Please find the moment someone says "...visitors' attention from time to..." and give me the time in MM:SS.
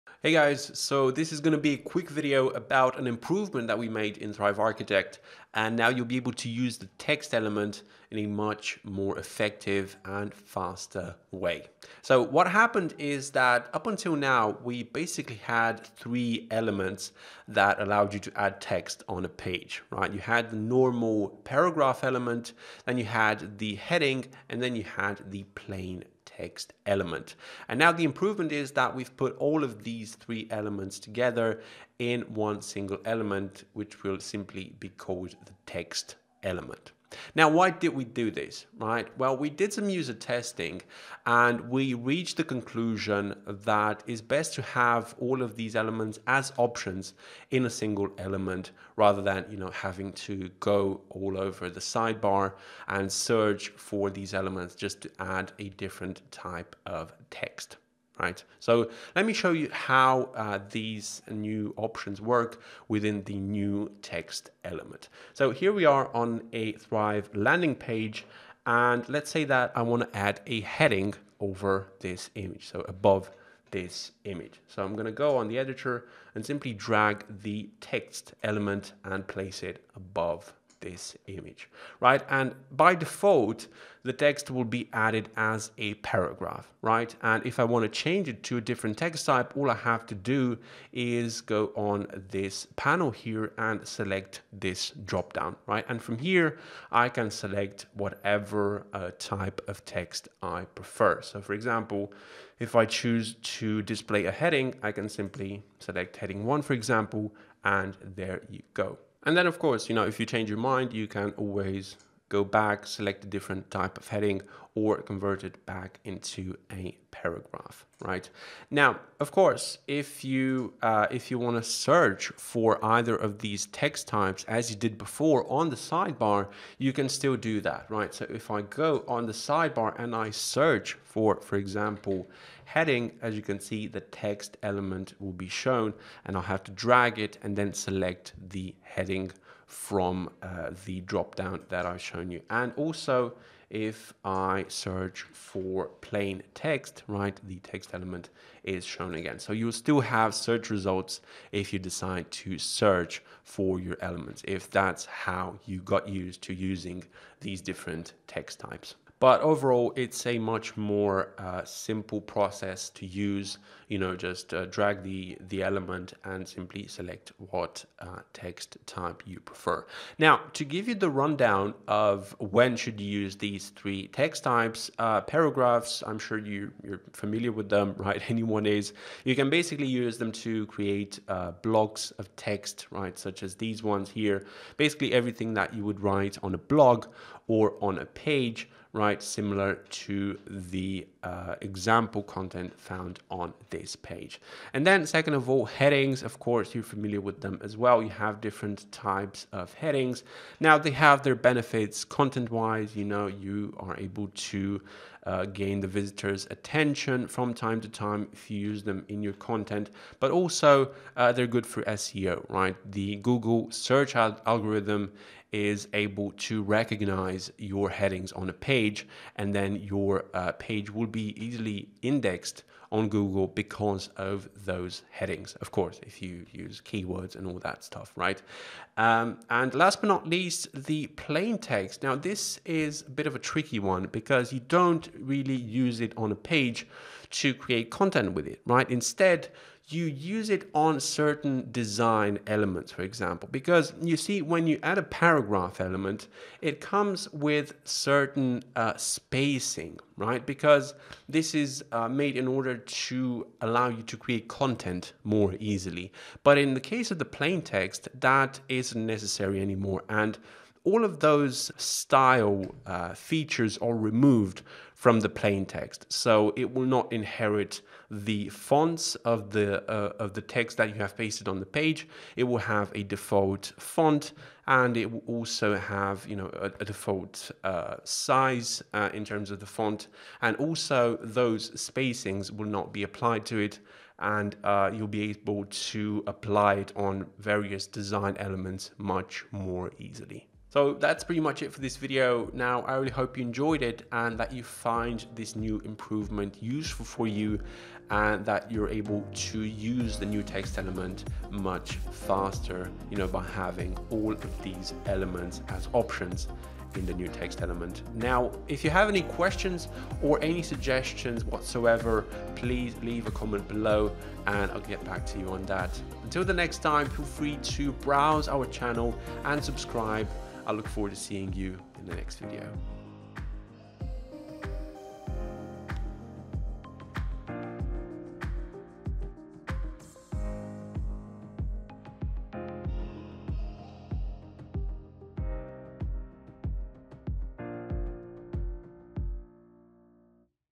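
03:25.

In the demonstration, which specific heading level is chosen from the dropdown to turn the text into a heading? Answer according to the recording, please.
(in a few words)
heading one.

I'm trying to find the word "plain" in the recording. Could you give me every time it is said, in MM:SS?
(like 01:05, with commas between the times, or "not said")
00:25, 02:26, 03:51, 04:17, 04:25.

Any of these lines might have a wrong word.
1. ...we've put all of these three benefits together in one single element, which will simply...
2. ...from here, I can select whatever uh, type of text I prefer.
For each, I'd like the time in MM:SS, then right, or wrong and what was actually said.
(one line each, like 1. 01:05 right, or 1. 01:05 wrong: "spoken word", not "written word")
1. 00:28 wrong: "elements", not "benefits"
2. 01:36 right.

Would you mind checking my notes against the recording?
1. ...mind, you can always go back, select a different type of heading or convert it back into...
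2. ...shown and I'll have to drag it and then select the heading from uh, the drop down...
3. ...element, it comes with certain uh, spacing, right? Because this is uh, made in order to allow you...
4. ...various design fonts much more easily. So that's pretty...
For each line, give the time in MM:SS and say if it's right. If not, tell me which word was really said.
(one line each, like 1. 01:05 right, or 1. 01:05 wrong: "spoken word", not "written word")
1. 01:50 right
2. 02:15 right
3. 04:05 right
4. 04:47 wrong: "elements", not "fonts".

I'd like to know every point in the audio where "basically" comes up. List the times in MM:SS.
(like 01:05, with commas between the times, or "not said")
00:14, 02:59, 03:04.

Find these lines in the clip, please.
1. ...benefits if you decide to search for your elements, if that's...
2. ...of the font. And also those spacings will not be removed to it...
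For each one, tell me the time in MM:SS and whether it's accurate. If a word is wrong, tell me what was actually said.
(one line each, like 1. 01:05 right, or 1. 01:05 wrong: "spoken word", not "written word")
1. 02:30 wrong: "results", not "benefits"
2. 04:39 wrong: "applied", not "removed".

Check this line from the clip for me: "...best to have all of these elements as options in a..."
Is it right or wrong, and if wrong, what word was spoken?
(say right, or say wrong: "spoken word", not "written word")
right.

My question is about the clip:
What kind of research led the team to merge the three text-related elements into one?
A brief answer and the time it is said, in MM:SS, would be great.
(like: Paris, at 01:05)
user testing, at 00:39.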